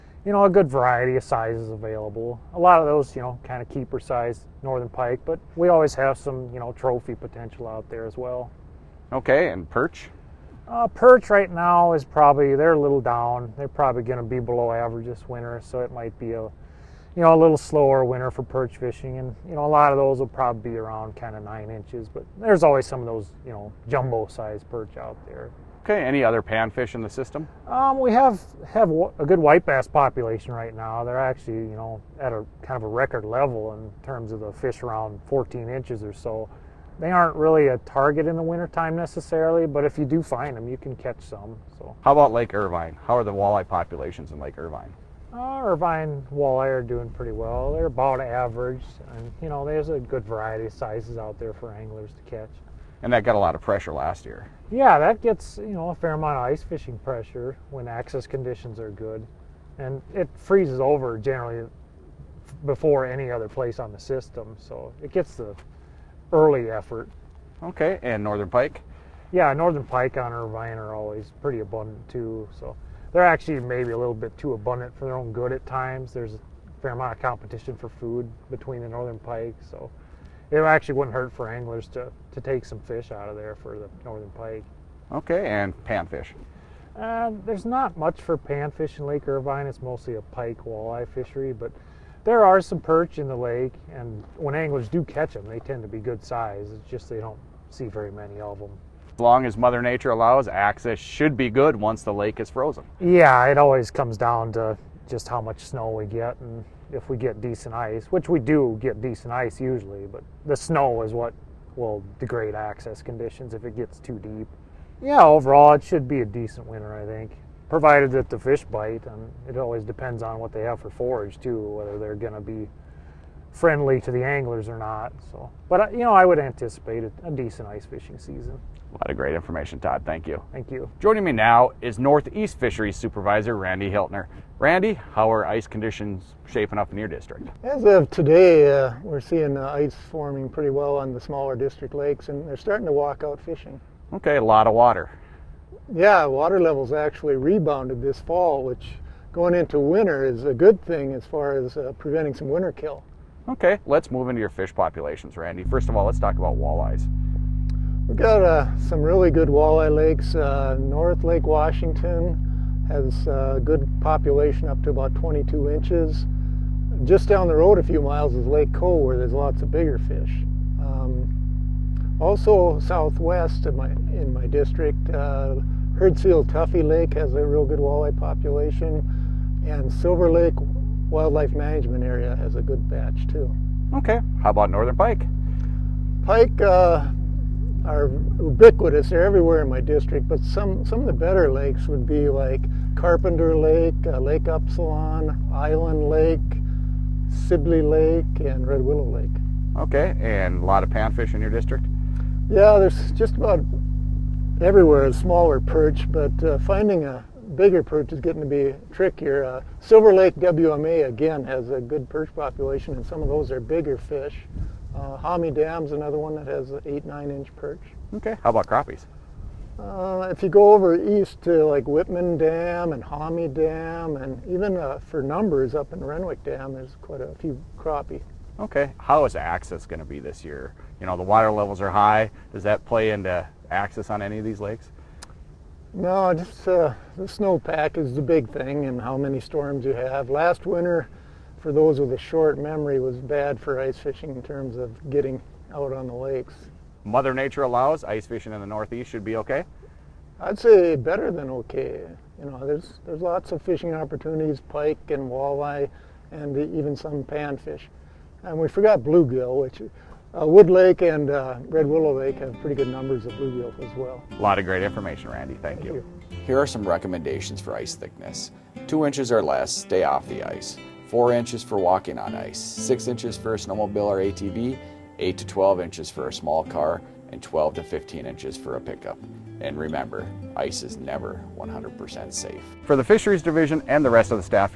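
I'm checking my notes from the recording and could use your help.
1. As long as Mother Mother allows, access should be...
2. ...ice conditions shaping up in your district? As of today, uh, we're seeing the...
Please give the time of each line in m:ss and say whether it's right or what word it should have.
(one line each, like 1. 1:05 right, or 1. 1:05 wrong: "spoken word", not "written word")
1. 1:39 wrong: "Nature", not "Mother"
2. 2:15 right.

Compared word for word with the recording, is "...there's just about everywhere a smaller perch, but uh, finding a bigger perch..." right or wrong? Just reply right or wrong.
right.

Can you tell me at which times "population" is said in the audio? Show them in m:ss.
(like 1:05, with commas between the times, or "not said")
0:29, 0:43, 2:34, 2:43, 2:58, 3:32.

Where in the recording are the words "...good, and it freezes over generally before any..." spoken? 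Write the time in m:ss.
0:58.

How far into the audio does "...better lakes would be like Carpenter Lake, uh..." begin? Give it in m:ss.
3:11.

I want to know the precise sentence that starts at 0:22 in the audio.
But there's always some of those you know jumbo size perch out there.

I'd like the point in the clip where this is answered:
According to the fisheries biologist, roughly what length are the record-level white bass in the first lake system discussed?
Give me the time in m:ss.
0:35.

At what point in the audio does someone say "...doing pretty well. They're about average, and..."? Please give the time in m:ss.
0:46.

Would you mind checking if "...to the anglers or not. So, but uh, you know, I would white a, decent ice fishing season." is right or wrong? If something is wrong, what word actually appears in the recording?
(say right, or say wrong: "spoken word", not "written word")
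wrong: "anticipate", not "white".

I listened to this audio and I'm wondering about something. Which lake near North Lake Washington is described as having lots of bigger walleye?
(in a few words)
Lake Cole.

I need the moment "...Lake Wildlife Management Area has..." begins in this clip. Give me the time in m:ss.
3:00.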